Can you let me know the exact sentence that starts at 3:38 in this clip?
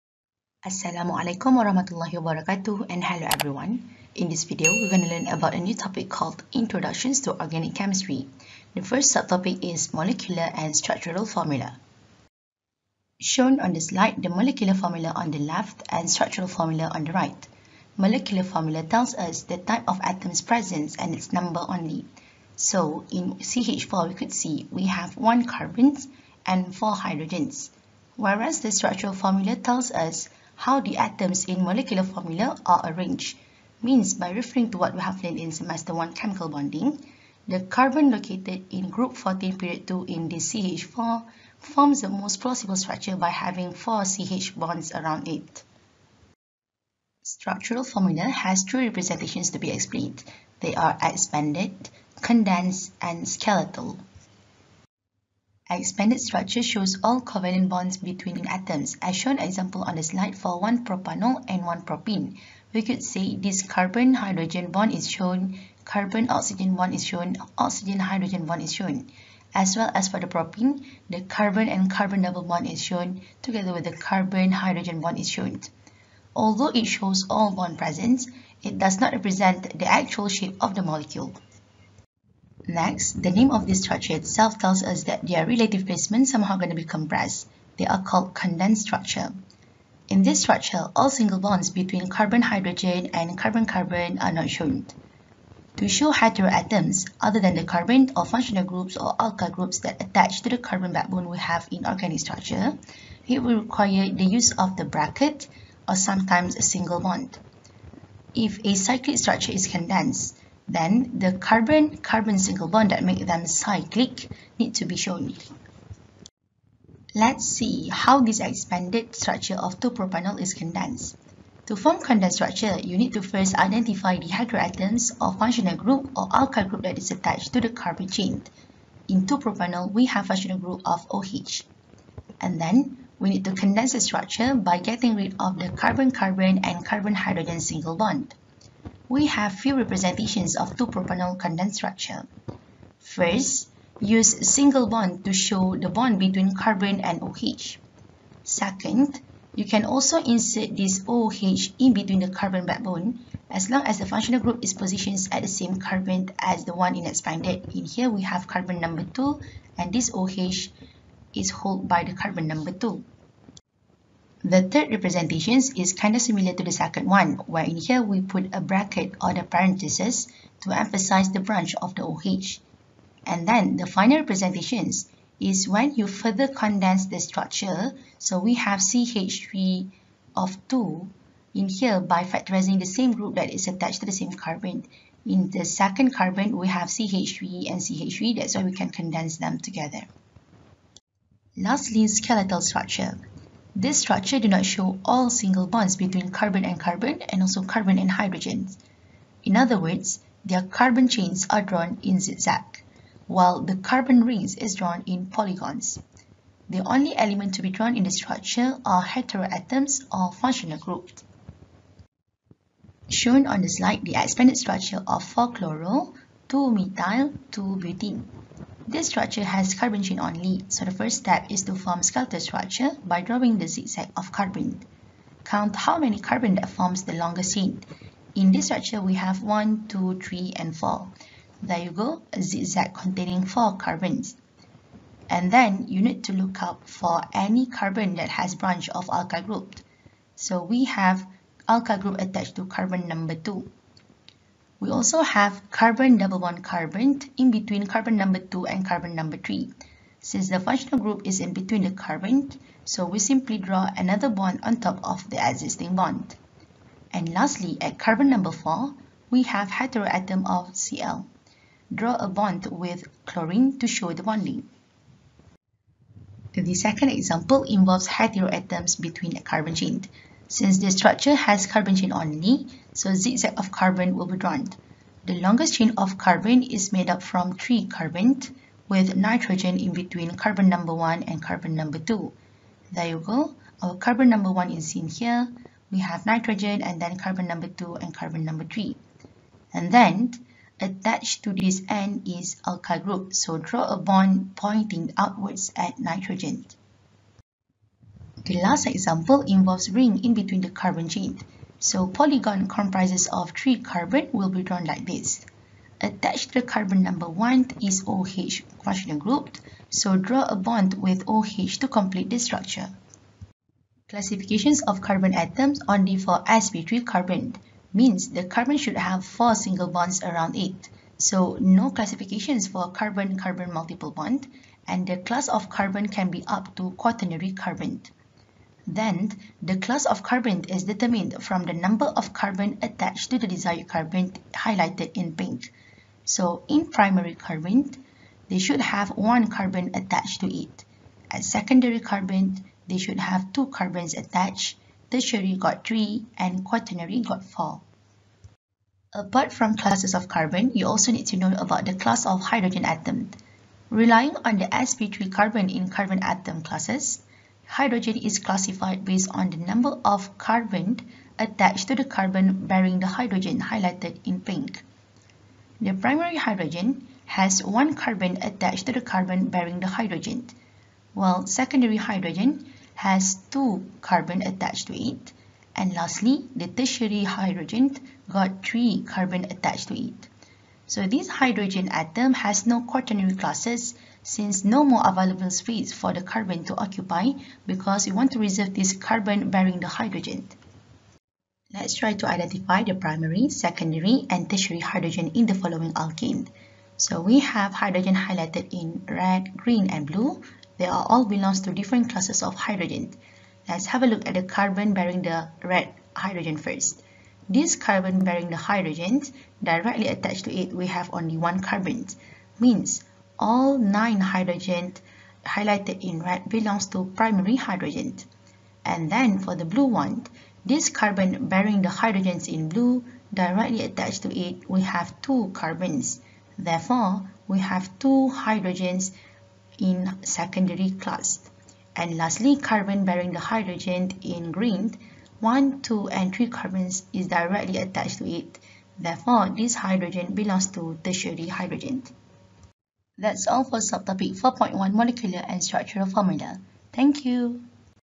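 This structure has carbon chain only, so the first step is to form skeletal structure by drawing the zigzag of carbon.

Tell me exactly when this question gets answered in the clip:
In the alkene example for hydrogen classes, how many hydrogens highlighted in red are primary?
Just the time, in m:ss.
6:53.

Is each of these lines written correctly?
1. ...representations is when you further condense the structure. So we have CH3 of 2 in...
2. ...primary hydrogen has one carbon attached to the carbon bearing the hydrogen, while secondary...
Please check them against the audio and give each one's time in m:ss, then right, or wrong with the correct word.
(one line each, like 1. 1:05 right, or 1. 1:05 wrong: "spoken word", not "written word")
1. 2:54 right
2. 6:05 right.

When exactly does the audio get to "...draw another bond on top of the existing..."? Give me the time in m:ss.
4:13.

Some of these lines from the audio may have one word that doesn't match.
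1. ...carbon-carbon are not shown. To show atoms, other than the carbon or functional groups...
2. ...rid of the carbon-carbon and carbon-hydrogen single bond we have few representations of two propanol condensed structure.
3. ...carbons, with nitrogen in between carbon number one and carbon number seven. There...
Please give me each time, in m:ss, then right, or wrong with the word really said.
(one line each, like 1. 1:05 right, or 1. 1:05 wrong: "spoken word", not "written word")
1. 1:33 wrong: "heteroatoms", not "atoms"
2. 2:15 right
3. 4:37 wrong: "two", not "seven".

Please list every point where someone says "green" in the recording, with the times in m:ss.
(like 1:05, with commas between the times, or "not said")
6:39, 7:14.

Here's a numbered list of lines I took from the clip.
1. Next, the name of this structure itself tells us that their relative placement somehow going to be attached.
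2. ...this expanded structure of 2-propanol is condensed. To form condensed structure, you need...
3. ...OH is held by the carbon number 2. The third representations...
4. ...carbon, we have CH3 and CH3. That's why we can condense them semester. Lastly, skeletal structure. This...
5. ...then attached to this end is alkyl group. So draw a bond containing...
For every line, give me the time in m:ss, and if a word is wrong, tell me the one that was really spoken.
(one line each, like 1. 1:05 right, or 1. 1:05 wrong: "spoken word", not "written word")
1. 1:22 wrong: "compressed", not "attached"
2. 1:58 right
3. 2:40 right
4. 3:06 wrong: "together", not "semester"
5. 4:49 wrong: "pointing", not "containing".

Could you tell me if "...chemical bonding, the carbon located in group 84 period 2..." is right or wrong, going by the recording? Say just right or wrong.
wrong.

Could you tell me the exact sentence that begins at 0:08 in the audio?
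The first subtopic is Molecular and Structural Formula.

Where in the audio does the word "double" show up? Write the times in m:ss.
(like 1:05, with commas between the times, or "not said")
1:12, 4:06.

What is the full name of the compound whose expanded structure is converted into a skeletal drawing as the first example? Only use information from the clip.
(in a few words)
4-chloro-2-methyl-2-butene.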